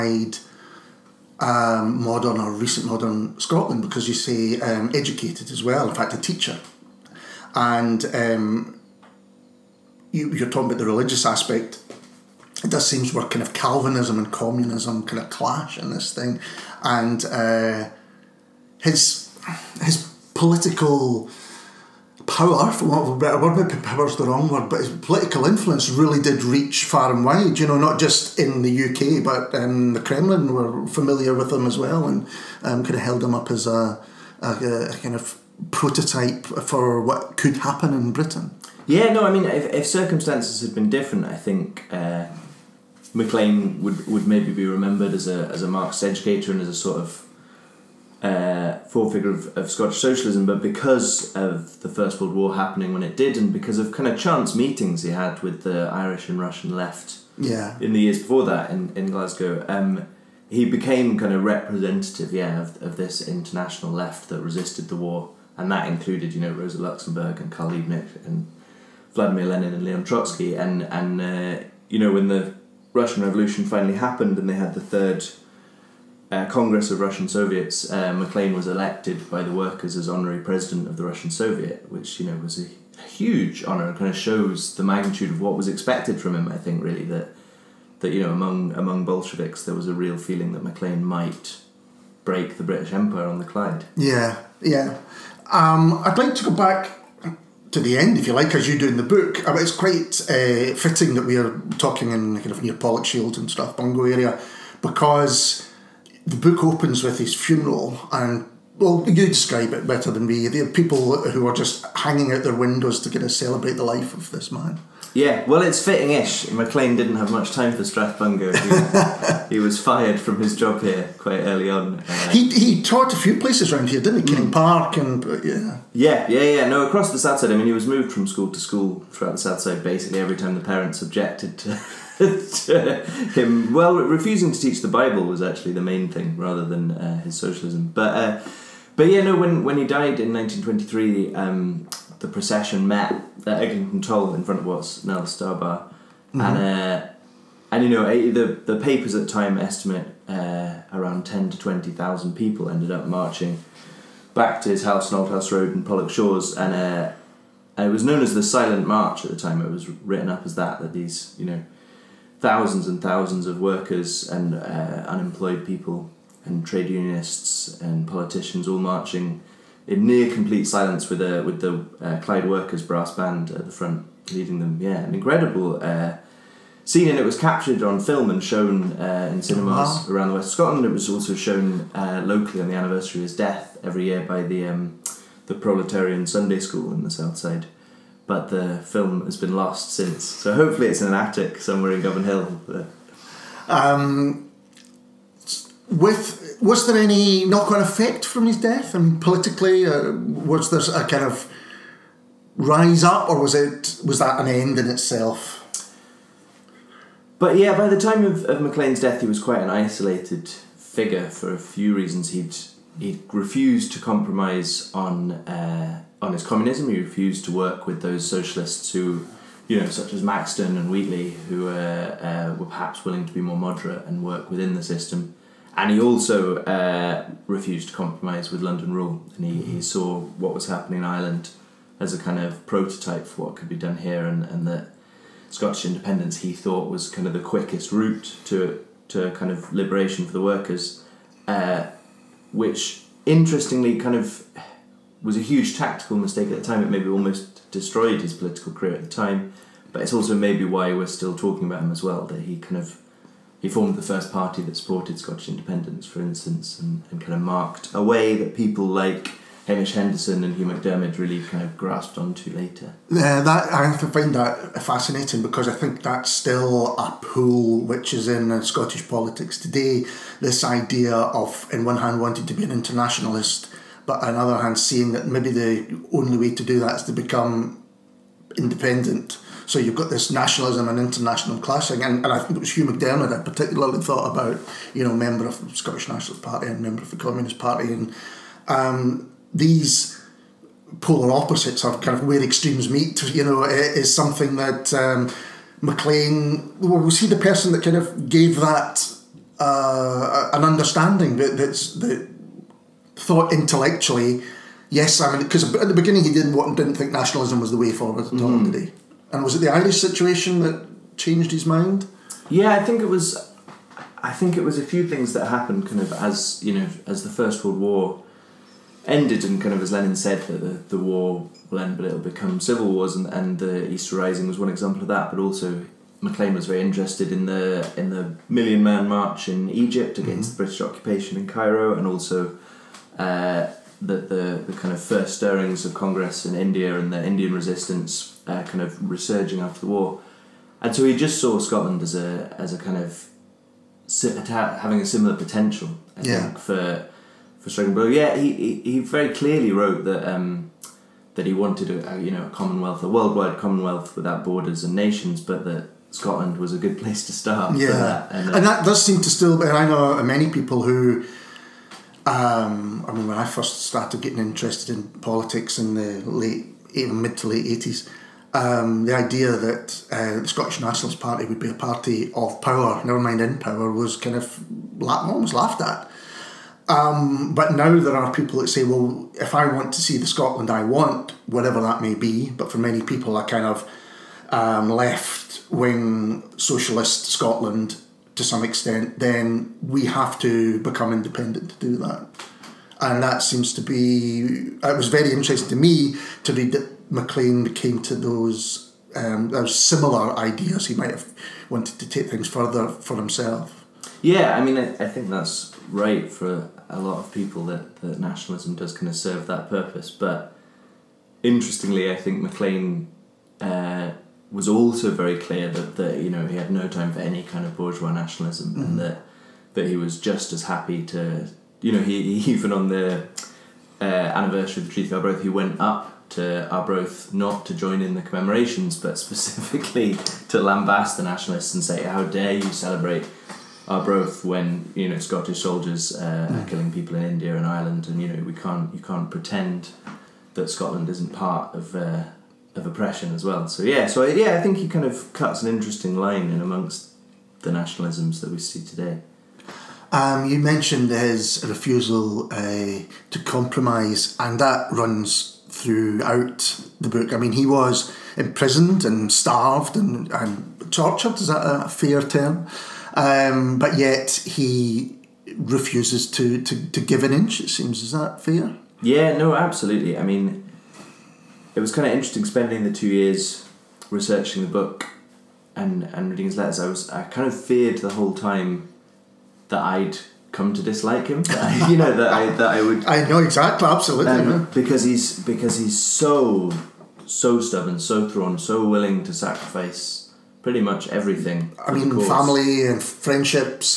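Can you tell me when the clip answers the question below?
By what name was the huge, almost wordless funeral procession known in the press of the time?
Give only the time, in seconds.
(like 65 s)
158 s.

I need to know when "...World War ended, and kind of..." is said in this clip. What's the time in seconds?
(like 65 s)
317 s.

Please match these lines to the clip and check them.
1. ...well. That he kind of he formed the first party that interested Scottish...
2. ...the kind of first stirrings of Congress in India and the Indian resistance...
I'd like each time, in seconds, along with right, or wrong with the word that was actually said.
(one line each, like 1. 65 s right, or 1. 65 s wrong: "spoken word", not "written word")
1. 252 s wrong: "supported", not "interested"
2. 334 s right.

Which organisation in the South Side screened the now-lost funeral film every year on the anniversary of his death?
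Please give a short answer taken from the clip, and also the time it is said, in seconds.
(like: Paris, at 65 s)
the Proletarian Sunday School, at 185 s.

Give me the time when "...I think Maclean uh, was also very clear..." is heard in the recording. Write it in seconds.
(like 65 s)
412 s.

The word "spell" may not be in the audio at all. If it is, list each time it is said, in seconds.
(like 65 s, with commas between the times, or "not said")
not said.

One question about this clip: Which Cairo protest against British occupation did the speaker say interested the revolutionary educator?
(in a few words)
the Million Man March.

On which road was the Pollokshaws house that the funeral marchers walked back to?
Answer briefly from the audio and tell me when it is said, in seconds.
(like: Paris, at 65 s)
Auldhouse Road, at 155 s.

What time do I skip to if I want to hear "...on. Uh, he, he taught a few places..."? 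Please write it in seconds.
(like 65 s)
121 s.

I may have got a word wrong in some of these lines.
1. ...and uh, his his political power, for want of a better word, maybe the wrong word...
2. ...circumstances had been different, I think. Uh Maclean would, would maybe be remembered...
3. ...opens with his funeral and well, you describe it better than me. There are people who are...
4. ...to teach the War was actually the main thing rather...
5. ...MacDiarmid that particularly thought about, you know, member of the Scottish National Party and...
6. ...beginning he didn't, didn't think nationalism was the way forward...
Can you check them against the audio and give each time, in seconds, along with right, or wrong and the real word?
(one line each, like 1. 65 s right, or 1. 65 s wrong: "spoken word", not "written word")
1. 16 s right
2. 39 s right
3. 106 s right
4. 134 s wrong: "Bible", not "War"
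5. 282 s right
6. 305 s right.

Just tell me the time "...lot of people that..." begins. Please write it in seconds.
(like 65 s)
406 s.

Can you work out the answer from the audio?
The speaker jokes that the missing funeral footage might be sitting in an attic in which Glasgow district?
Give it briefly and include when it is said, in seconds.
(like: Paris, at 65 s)
Govanhill, at 192 s.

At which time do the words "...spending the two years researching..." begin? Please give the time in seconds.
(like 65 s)
472 s.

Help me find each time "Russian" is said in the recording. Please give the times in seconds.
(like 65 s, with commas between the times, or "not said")
56 s, 72 s, 77 s, 81 s.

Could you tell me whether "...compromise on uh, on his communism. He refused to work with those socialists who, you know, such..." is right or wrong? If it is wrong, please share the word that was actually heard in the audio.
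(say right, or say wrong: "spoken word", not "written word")
right.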